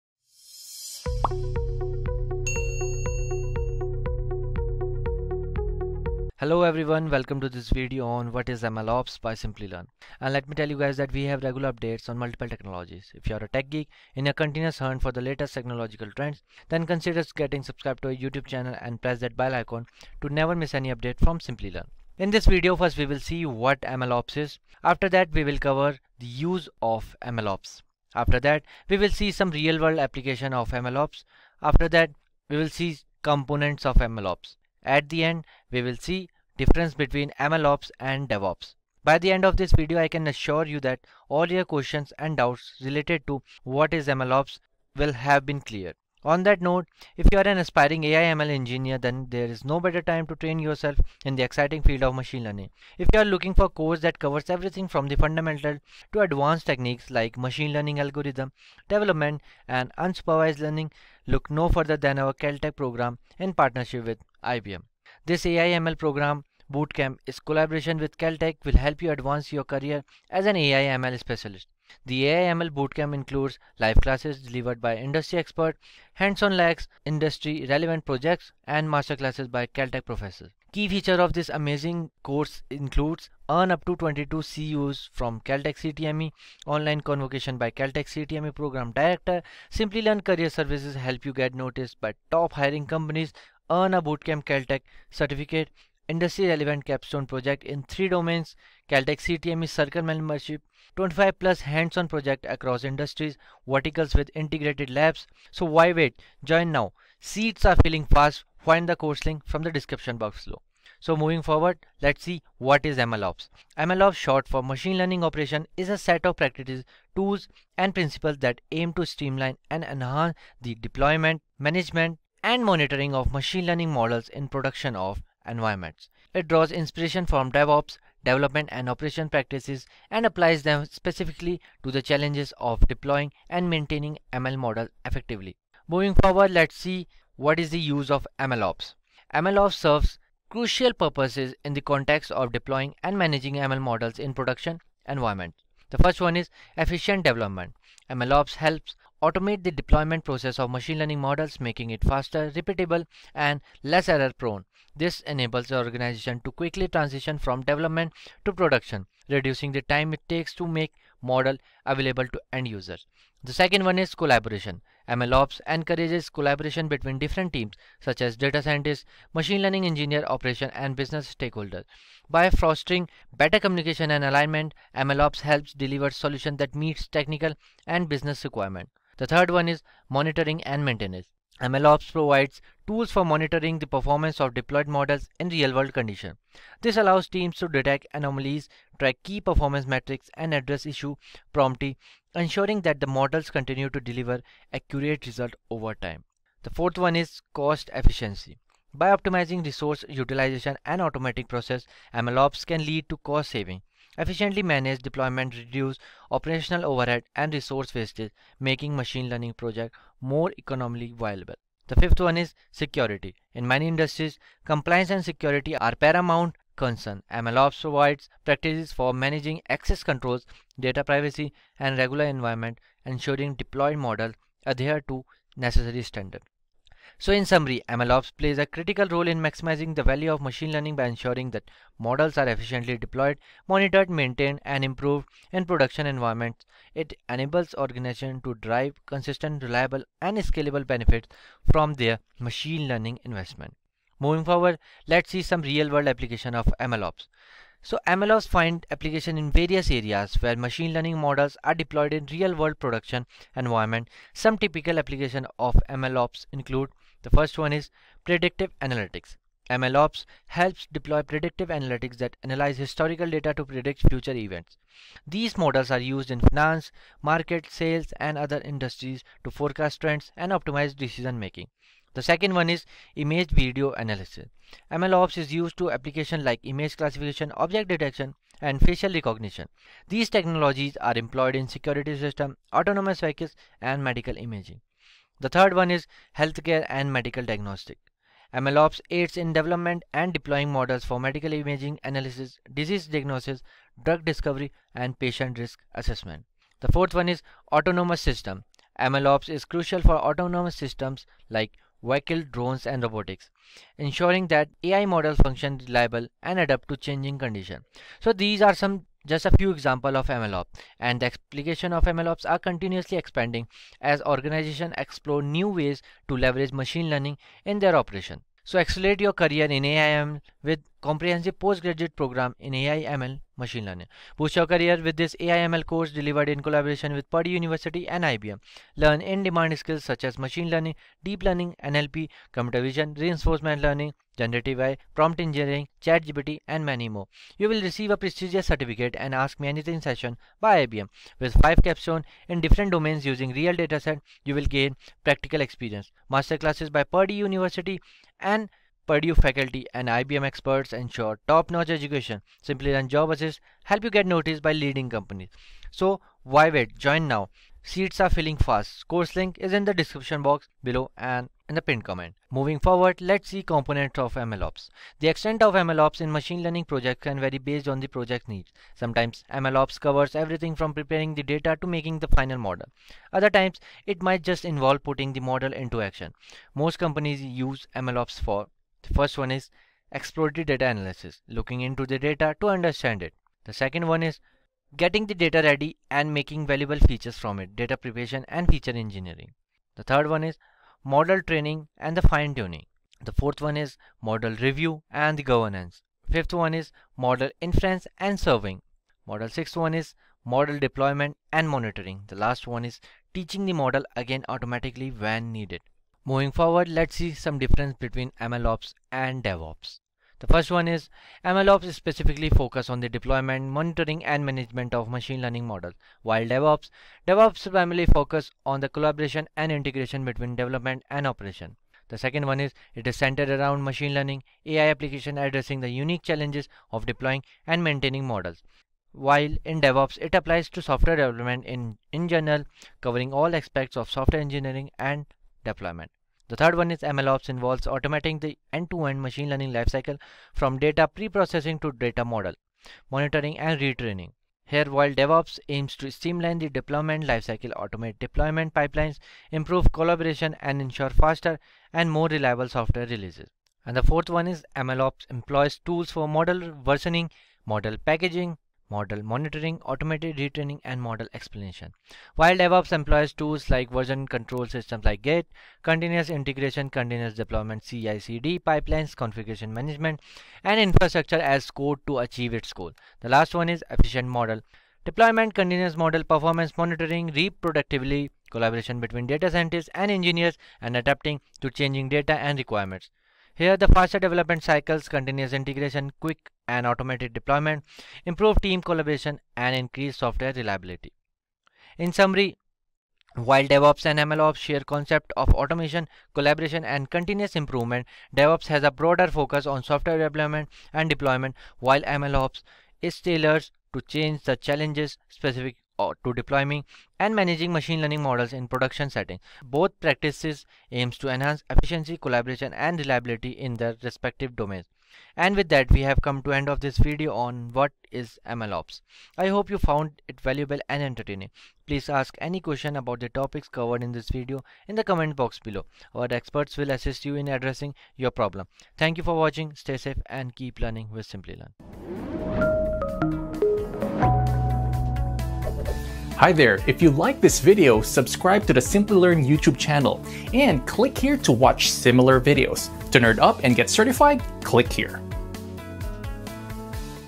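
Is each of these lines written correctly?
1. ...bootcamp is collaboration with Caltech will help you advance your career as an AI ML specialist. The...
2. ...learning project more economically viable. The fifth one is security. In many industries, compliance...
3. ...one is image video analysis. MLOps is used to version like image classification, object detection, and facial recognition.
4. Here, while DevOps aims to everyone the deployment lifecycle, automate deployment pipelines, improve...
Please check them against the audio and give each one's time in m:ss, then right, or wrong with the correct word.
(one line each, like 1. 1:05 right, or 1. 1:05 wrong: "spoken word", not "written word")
1. 1:06 right
2. 3:29 right
3. 4:32 wrong: "application", not "version"
4. 7:24 wrong: "streamline", not "everyone".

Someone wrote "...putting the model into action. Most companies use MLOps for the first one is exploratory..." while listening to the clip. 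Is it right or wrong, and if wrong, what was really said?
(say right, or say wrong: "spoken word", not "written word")
right.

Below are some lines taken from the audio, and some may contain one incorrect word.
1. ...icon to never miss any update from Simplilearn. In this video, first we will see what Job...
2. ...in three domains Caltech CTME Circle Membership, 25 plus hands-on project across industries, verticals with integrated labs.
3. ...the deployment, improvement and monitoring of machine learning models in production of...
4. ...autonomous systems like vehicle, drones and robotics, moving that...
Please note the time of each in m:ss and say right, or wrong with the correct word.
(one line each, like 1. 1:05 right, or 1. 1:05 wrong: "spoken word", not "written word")
1. 0:19 wrong: "MLOps", not "Job"
2. 1:37 right
3. 2:00 wrong: "management", not "improvement"
4. 5:00 wrong: "ensuring", not "moving".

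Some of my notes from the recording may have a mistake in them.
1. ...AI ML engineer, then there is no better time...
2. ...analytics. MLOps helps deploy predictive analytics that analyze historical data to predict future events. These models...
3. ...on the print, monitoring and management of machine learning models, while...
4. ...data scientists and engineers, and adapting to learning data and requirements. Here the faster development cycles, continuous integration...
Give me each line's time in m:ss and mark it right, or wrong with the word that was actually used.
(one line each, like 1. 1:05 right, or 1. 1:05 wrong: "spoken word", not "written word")
1. 0:48 right
2. 4:18 right
3. 6:52 wrong: "deployment", not "print"
4. 7:59 wrong: "changing", not "learning".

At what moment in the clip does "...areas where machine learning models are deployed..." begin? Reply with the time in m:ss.
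4:09.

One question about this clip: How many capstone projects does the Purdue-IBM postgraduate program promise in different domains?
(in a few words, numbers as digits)
5.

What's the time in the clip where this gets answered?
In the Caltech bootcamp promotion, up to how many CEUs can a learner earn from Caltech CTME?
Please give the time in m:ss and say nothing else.
1:23.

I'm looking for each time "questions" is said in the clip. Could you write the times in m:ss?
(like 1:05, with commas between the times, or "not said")
0:41, 8:42.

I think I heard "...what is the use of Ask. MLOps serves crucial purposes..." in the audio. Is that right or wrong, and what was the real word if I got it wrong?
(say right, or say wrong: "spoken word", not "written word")
wrong: "MLOps", not "Ask".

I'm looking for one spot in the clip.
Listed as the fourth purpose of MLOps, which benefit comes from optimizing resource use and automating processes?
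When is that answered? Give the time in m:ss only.
3:17.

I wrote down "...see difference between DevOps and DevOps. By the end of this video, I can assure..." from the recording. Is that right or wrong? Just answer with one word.
wrong.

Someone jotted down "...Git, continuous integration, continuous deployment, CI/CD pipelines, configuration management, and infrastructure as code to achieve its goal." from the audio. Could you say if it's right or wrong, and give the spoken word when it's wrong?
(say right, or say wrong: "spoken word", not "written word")
right.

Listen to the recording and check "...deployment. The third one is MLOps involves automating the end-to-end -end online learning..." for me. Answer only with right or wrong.
wrong.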